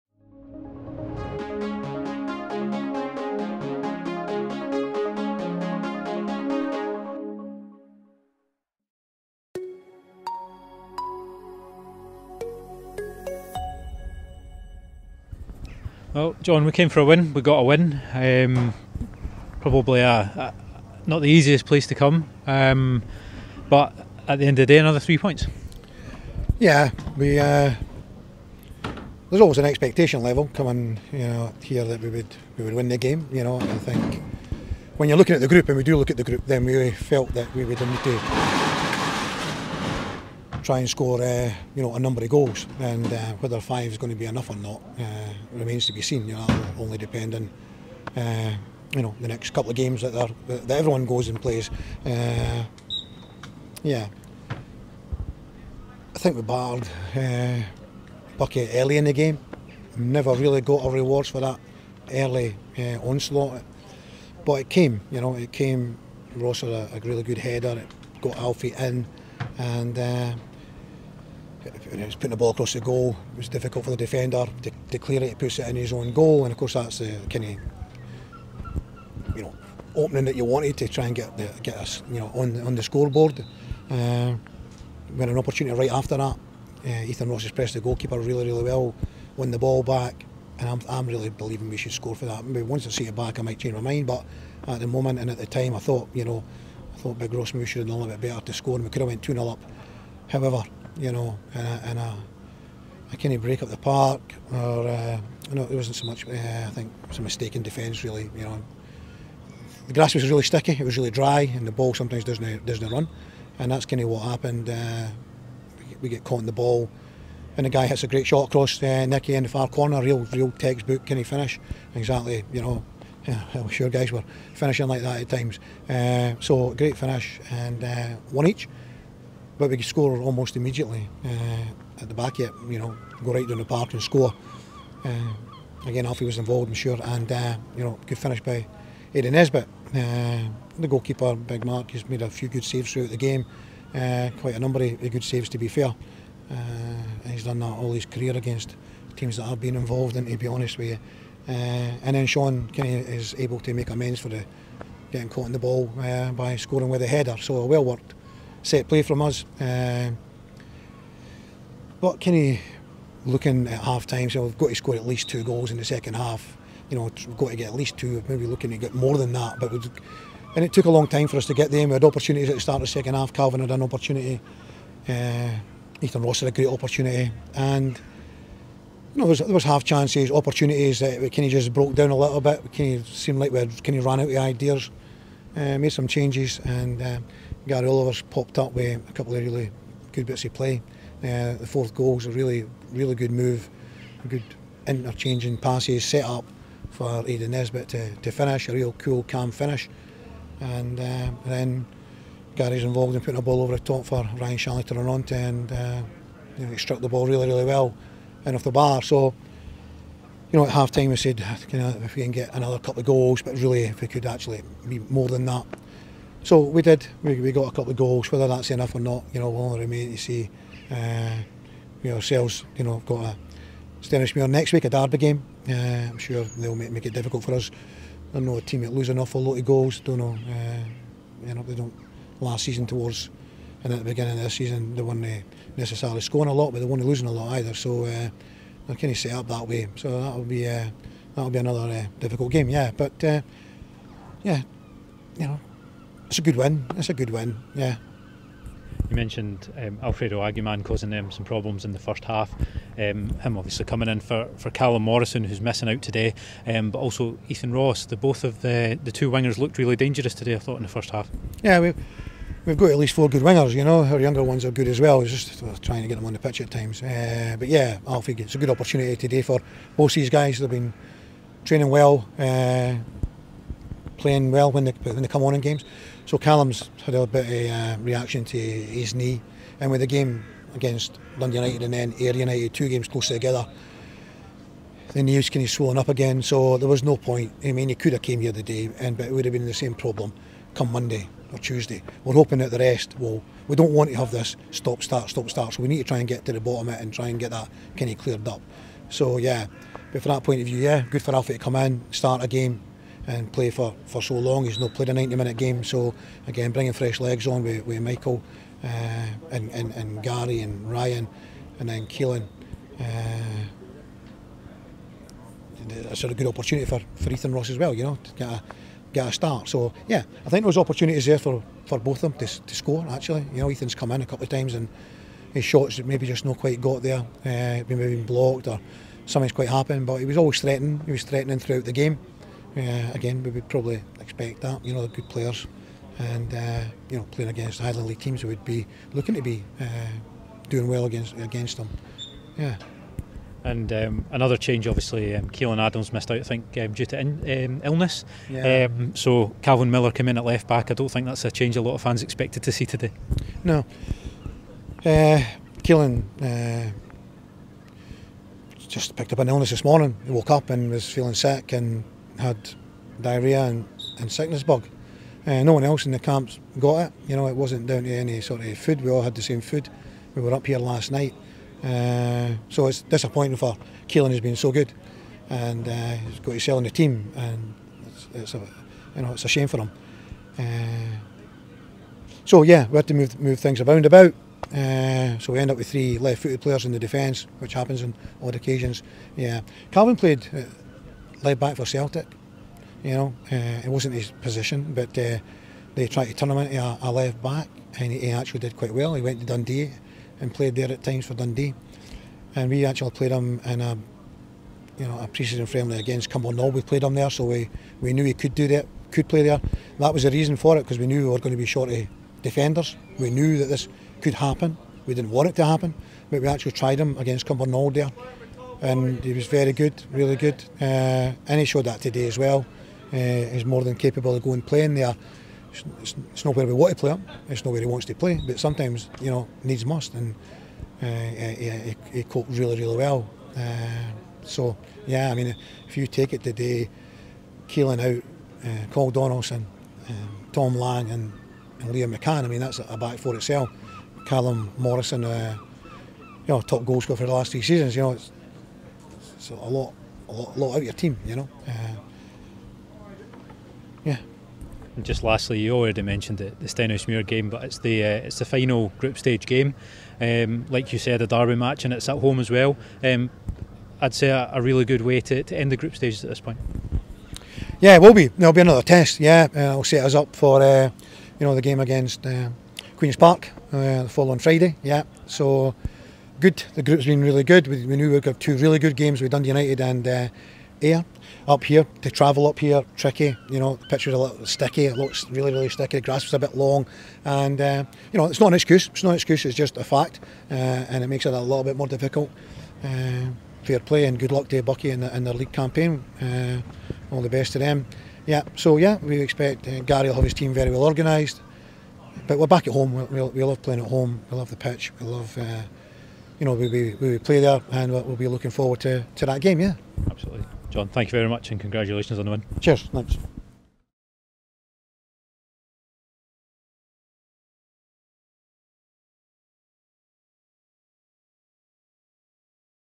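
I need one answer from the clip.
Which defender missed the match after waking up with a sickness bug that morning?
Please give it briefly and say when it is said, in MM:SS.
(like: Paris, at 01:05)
Keelan Adams, at 05:45.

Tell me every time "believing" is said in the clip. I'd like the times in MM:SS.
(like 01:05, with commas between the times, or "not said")
01:31.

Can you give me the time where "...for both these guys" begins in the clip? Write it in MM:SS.
04:29.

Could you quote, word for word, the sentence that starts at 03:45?
Uh, I'm sure they'll make, make it difficult for us.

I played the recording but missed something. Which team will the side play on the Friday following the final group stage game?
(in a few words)
Queens Park.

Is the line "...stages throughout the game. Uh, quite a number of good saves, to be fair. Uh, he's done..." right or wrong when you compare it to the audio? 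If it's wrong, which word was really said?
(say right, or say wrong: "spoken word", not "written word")
wrong: "saves", not "stages".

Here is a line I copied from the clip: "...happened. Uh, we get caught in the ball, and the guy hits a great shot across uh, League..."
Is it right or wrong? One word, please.
wrong.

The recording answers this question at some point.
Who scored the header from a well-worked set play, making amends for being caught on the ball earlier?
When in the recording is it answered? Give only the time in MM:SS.
02:32.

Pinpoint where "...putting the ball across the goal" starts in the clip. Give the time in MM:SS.
01:12.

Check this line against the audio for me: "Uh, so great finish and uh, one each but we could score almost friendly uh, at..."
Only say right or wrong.
wrong.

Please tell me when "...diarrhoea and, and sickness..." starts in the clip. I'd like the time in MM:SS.
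06:03.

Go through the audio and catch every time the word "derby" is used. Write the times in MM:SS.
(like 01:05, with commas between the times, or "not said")
03:44, 07:41.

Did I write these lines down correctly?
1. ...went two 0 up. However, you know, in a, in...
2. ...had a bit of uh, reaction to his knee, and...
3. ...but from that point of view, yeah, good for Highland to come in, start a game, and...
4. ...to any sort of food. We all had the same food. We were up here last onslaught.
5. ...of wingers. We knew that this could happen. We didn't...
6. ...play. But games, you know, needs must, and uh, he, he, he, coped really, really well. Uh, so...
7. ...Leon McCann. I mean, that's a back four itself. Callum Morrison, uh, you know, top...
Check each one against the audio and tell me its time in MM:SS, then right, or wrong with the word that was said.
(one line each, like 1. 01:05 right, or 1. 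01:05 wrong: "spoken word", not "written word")
1. 01:39 right
2. 04:37 right
3. 05:00 wrong: "Alfie", not "Highland"
4. 06:08 wrong: "night", not "onslaught"
5. 06:51 wrong: "defenders", not "wingers"
6. 07:08 wrong: "sometimes", not "games"
7. 07:21 right.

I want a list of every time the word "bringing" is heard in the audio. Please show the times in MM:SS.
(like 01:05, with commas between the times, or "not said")
05:06.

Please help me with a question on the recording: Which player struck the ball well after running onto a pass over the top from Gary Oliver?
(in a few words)
Ryan Shawley.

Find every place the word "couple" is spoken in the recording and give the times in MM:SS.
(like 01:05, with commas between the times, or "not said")
00:49, 03:09, 03:32, 03:37, 05:24.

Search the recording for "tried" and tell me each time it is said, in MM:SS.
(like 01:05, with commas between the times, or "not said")
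06:36, 06:56.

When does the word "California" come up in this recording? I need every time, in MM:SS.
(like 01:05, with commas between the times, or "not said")
not said.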